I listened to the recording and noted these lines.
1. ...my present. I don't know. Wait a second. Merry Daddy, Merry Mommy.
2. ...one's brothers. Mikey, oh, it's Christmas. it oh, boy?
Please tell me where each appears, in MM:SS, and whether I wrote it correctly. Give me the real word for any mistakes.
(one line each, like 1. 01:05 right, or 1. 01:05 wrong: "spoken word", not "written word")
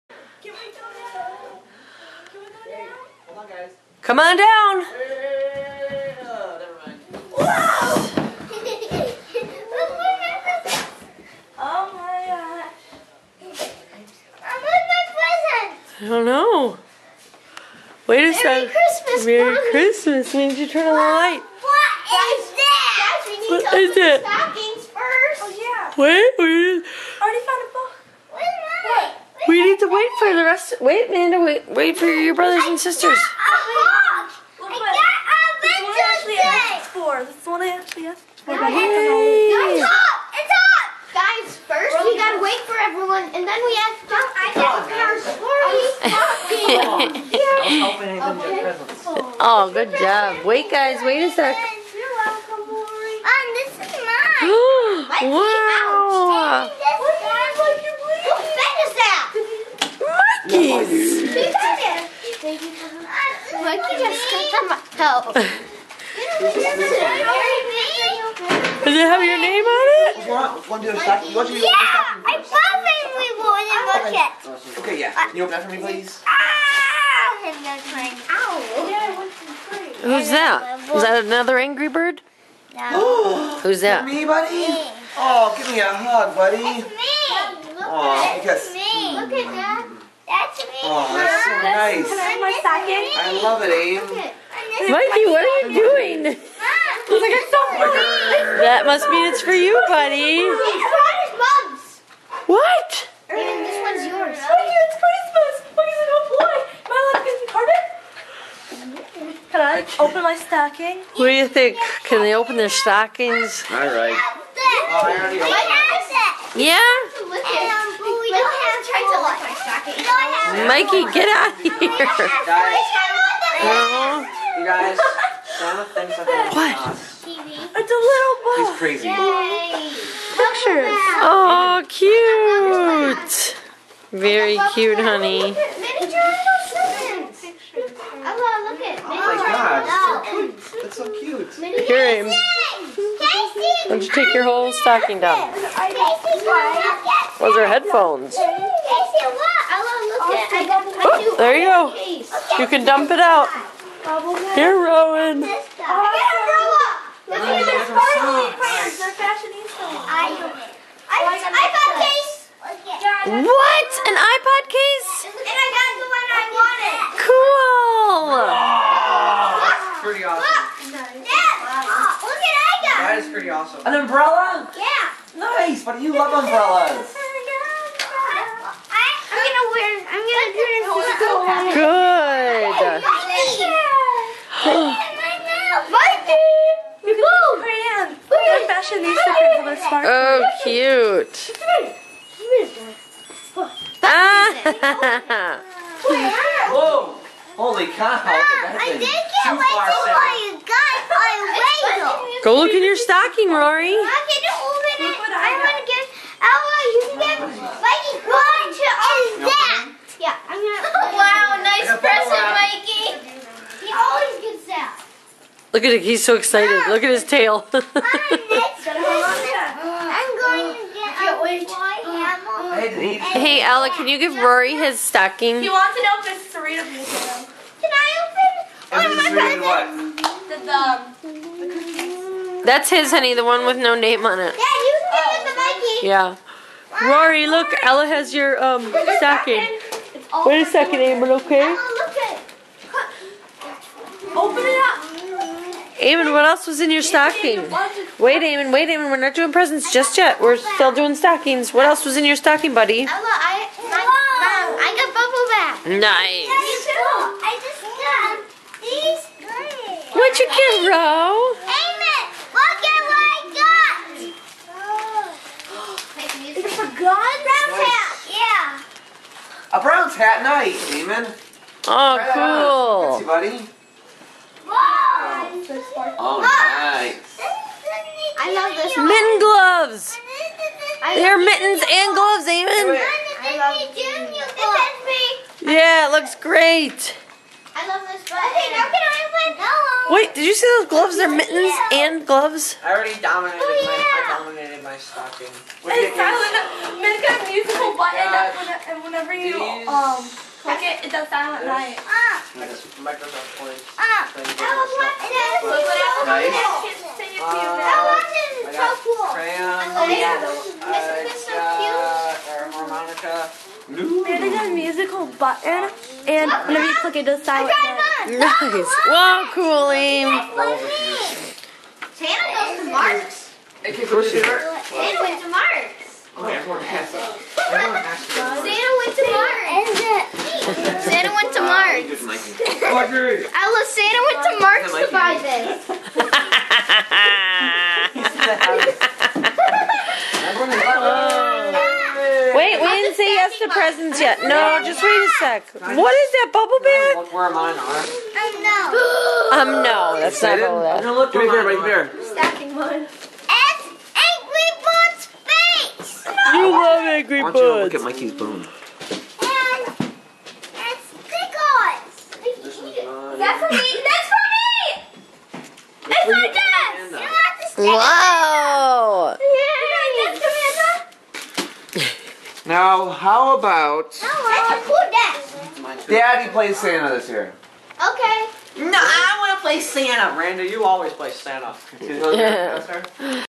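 1. 00:14 wrong: "Christmas", not "Daddy"
2. 01:43 wrong: "yours", not "brothers".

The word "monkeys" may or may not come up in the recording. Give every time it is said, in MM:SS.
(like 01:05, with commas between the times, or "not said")
01:00.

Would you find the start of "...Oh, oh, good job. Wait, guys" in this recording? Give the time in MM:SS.
00:47.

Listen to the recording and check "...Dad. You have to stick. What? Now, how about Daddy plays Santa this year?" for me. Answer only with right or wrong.
right.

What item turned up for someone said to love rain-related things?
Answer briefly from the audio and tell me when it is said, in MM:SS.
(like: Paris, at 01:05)
An umbrella, at 02:53.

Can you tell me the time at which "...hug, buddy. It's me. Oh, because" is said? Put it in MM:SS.
01:25.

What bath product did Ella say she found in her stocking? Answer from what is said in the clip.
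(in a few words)
Bubble bath.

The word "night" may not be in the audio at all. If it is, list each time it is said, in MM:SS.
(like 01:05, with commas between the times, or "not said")
04:30, 05:01, 05:17.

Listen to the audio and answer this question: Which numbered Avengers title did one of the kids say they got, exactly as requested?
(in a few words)
Four.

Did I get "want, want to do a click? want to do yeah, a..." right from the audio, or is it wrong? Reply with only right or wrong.
wrong.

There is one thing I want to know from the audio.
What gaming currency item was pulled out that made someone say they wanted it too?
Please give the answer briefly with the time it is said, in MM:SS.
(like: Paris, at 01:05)
Microsoft points, at 05:02.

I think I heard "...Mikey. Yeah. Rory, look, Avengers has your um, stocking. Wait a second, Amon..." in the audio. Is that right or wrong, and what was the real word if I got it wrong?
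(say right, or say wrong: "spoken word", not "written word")
wrong: "Ella", not "Avengers".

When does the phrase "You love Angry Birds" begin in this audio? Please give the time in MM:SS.
05:56.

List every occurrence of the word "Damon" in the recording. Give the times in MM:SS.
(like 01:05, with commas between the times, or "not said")
04:30, 04:42.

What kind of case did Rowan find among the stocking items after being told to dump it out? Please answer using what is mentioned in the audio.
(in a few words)
iPod case.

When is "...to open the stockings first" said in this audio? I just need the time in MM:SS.
00:23.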